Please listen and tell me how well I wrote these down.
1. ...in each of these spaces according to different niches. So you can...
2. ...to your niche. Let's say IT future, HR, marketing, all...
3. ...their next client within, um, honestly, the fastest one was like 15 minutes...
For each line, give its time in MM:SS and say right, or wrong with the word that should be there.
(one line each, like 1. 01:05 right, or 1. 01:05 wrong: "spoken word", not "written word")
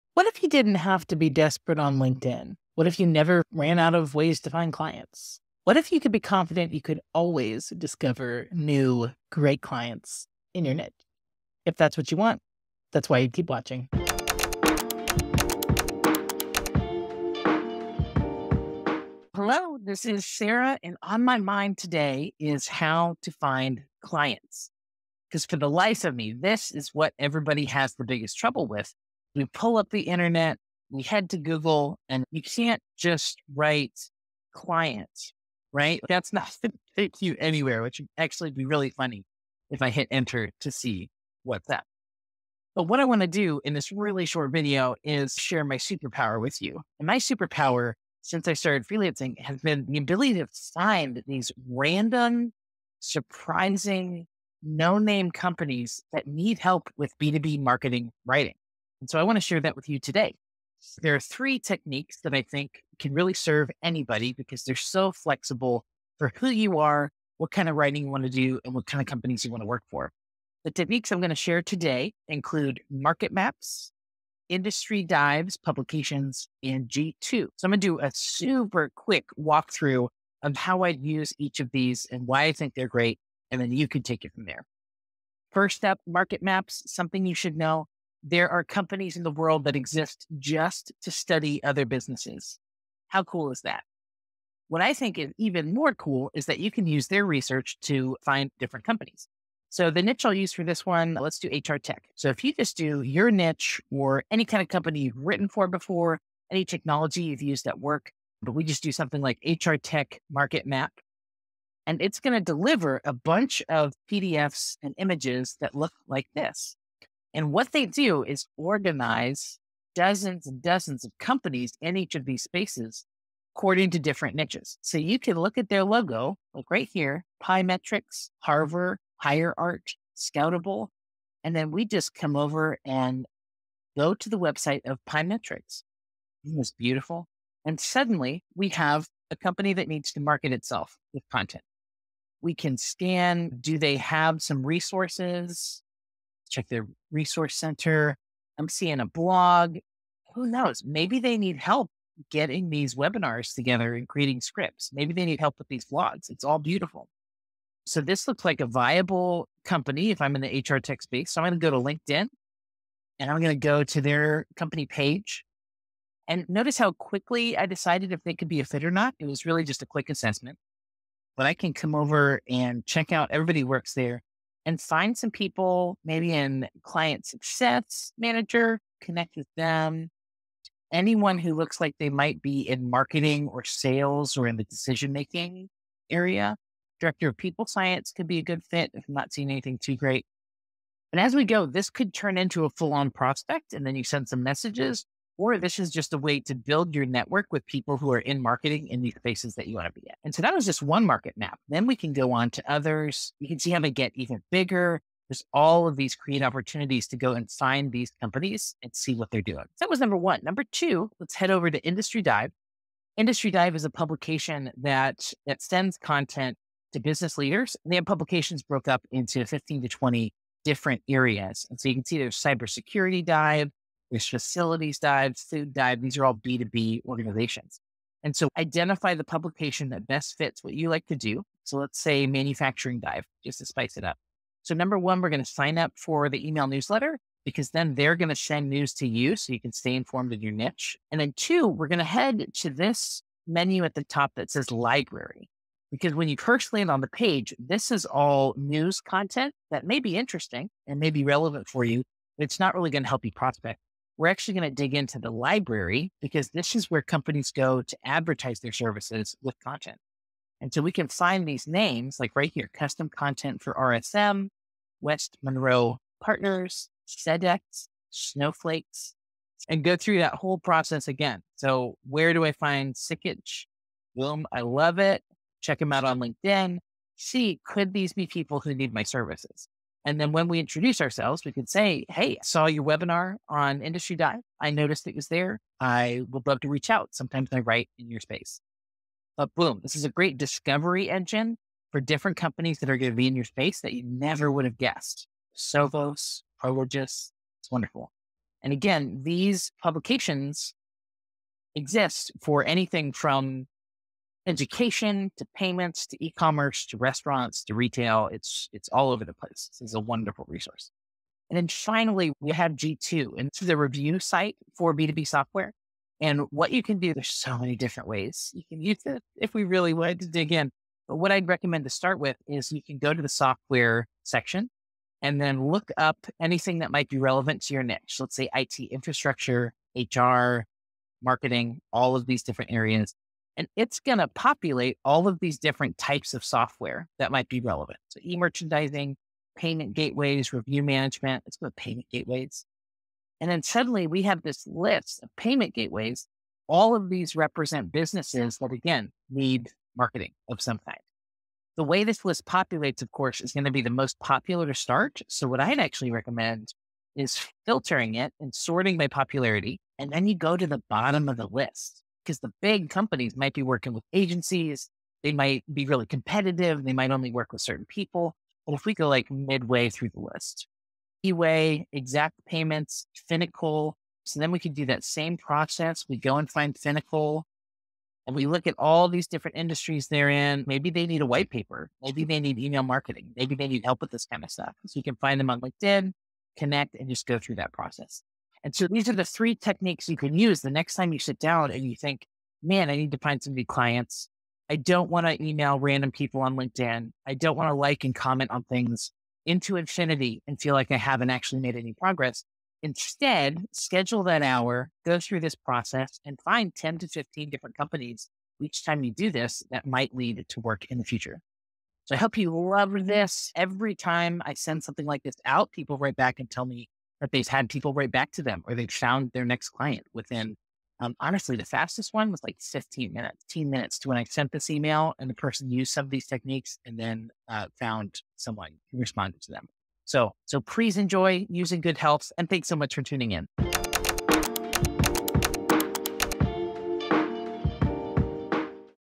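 1. 02:01 right
2. 05:27 wrong: "infrastructure", not "future"
3. 06:59 right.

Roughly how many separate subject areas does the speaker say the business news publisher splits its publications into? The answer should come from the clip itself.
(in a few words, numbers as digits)
15 to 20.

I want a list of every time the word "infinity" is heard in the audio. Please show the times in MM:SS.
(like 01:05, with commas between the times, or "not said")
06:39.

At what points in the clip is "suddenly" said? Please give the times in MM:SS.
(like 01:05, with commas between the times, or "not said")
02:17, 05:43.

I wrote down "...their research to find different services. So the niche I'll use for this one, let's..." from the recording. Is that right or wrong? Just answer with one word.
wrong.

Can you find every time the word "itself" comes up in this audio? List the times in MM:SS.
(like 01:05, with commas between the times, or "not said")
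02:20.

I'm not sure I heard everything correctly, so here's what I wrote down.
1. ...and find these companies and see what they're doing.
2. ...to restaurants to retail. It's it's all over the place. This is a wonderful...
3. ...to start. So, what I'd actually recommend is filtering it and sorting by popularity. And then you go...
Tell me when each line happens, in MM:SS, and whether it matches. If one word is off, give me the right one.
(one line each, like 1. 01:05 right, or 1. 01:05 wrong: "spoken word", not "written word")
1. 03:27 right
2. 05:06 right
3. 05:54 right.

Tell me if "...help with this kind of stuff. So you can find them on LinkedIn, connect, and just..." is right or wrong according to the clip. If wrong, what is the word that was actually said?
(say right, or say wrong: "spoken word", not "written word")
right.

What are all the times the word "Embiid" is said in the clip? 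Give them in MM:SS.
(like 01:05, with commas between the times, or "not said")
not said.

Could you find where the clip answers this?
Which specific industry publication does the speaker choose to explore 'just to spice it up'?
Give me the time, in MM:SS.
03:52.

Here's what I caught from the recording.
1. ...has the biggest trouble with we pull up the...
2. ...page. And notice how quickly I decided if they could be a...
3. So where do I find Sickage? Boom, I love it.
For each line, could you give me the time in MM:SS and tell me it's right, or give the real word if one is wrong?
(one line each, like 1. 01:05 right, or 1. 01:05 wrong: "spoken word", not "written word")
1. 00:27 right
2. 02:44 right
3. 04:31 right.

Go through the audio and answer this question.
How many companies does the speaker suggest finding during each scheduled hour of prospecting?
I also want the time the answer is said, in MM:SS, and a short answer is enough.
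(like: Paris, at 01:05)
10 to 15, at 06:46.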